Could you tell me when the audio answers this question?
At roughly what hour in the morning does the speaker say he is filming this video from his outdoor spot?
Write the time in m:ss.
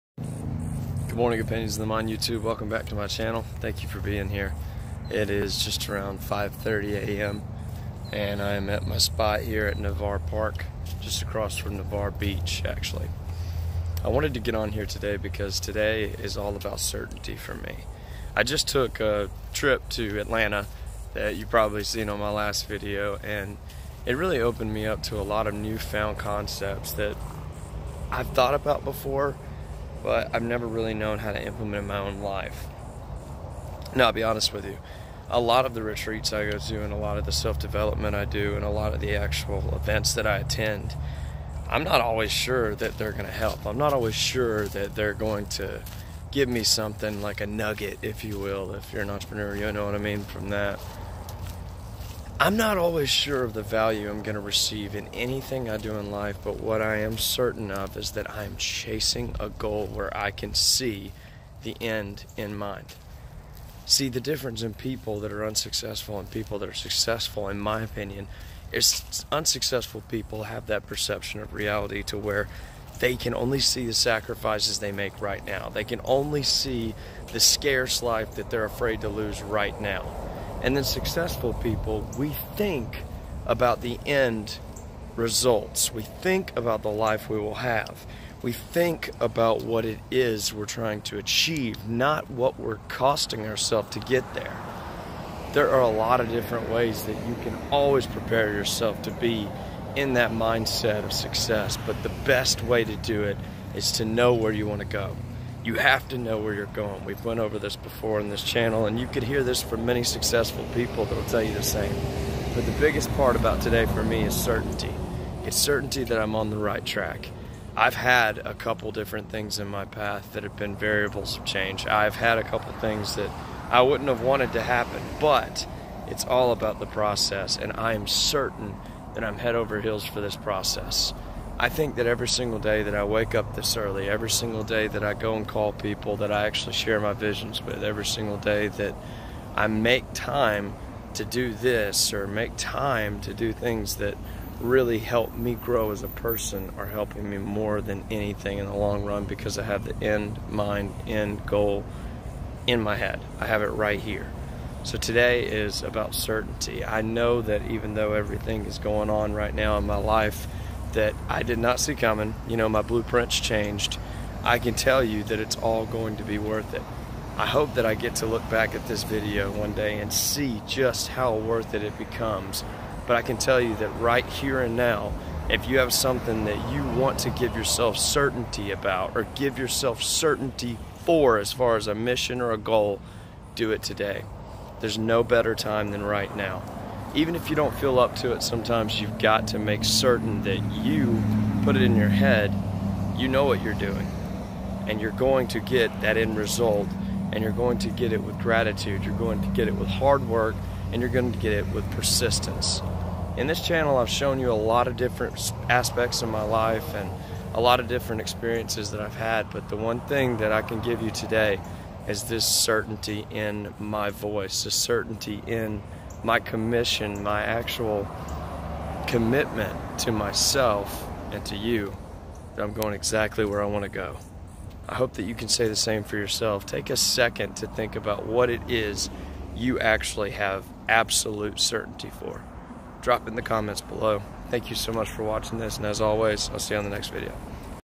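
0:06.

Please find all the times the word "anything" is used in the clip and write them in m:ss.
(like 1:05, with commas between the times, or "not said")
0:55, 2:28.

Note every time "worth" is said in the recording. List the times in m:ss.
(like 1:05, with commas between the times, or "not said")
2:46, 2:51.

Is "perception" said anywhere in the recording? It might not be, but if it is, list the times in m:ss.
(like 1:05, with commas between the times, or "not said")
1:10.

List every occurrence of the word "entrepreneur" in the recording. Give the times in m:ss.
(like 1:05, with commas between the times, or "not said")
0:49.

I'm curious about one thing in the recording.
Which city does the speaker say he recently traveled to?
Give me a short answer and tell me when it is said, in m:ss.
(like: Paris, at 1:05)
Atlanta, at 0:20.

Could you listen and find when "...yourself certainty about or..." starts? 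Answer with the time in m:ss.
2:57.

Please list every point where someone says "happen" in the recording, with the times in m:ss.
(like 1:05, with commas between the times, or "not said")
2:04.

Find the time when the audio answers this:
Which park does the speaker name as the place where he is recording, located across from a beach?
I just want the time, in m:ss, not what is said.
0:09.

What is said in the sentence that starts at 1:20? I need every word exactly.
And then successful people, we think about the end results.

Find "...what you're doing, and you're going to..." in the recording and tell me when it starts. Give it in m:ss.
3:13.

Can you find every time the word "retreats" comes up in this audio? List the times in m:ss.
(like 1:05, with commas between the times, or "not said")
0:35.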